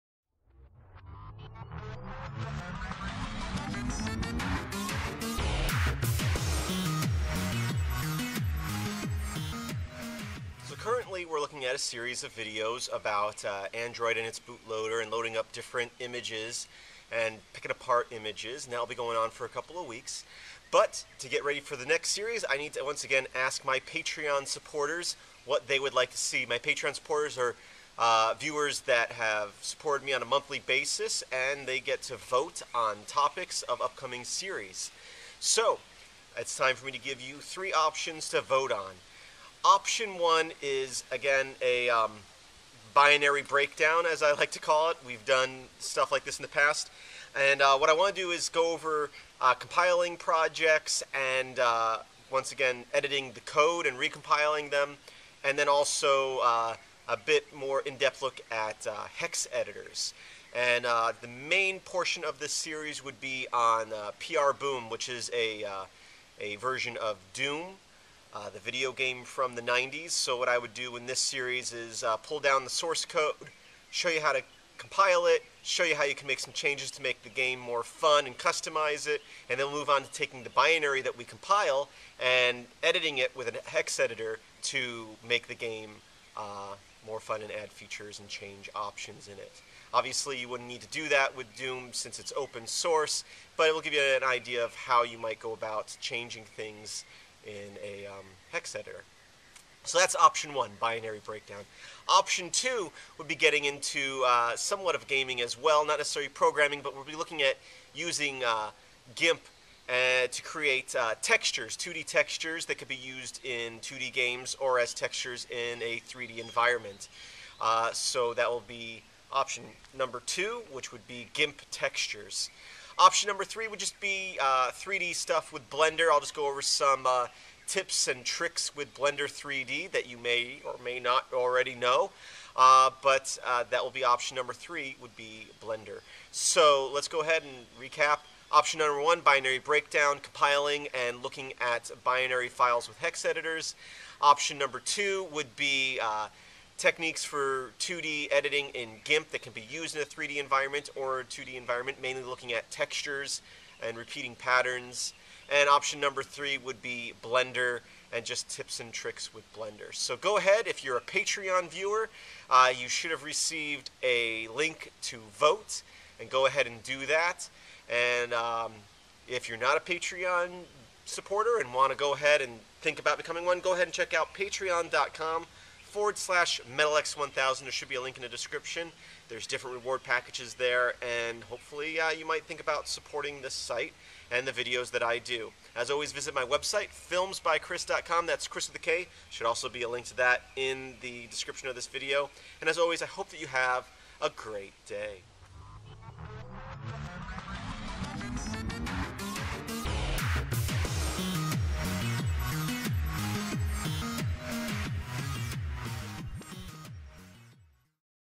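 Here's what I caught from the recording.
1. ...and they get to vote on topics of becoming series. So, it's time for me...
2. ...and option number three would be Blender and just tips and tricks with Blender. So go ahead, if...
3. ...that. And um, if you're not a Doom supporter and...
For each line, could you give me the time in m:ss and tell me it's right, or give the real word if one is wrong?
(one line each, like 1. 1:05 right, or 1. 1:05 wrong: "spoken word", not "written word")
1. 0:31 wrong: "upcoming", not "becoming"
2. 2:35 right
3. 2:47 wrong: "Patreon", not "Doom".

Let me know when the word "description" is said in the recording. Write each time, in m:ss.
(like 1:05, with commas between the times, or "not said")
2:58, 3:11.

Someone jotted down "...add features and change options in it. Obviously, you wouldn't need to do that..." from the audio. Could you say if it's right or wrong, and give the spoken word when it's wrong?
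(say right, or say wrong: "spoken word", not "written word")
right.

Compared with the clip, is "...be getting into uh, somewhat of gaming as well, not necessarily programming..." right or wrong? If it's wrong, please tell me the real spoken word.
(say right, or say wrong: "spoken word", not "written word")
right.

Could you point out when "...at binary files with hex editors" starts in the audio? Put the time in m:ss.
2:21.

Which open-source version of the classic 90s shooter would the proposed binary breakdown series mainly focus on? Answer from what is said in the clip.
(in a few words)
PrBoom.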